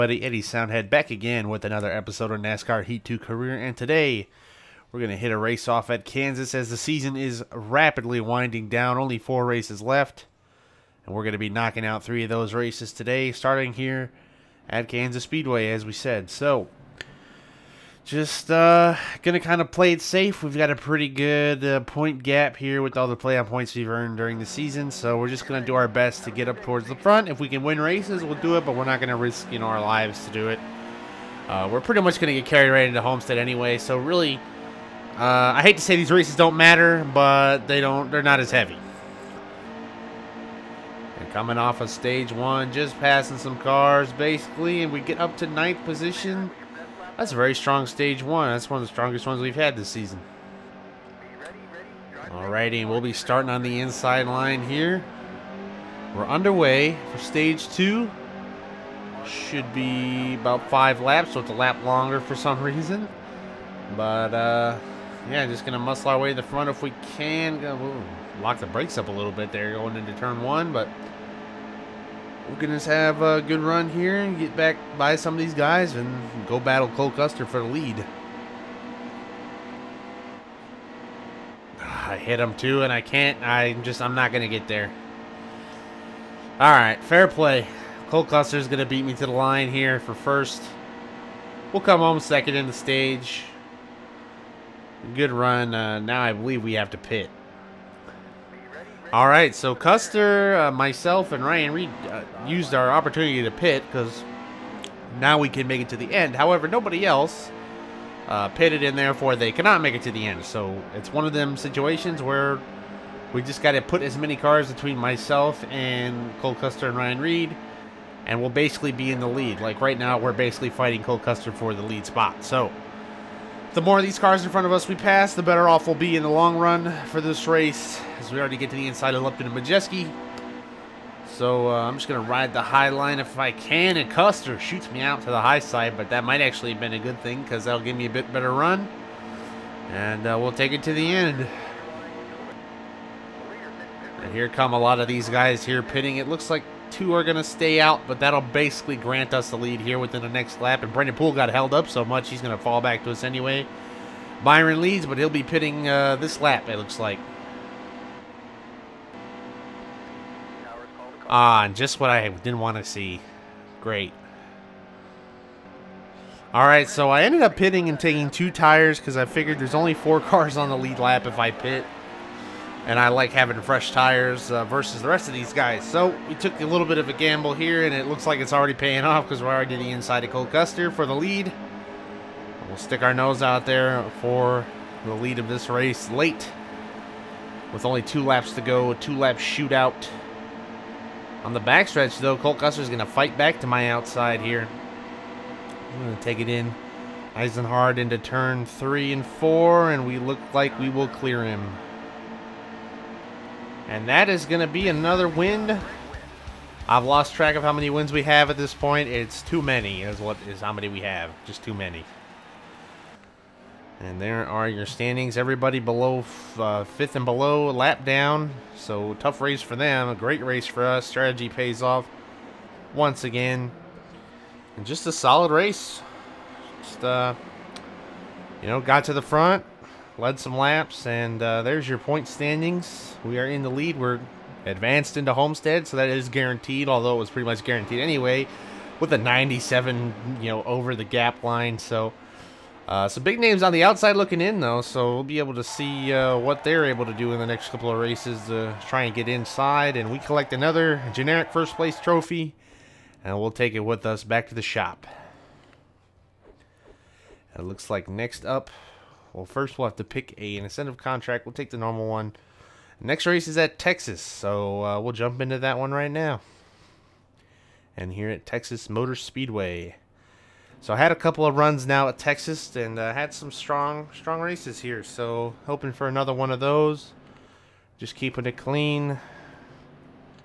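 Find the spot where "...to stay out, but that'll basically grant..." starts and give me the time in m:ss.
2:27.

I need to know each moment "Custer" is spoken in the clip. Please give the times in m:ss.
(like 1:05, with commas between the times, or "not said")
1:17, 1:28, 1:39, 1:56, 2:01, 2:14, 3:00, 3:12.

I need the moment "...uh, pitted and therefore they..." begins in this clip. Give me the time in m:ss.
1:48.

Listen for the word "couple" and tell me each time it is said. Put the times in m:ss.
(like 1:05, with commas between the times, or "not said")
4:07, 4:31.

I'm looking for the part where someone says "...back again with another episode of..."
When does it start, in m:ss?
0:00.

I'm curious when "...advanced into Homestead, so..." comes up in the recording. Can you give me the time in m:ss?
3:54.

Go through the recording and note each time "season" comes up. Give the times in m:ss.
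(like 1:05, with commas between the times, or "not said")
0:06, 0:24, 0:49.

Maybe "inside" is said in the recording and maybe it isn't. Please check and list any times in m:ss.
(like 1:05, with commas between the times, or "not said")
0:53, 2:08, 2:59, 4:09.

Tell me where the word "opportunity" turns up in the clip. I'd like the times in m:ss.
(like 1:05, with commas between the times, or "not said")
1:42.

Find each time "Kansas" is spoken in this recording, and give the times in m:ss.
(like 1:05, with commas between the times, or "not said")
0:06, 0:14.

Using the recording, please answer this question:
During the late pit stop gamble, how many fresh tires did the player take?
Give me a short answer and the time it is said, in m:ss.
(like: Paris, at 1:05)
2, at 2:48.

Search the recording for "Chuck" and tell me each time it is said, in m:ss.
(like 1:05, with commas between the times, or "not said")
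not said.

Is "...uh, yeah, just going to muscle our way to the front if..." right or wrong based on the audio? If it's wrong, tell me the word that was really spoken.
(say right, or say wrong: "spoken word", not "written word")
right.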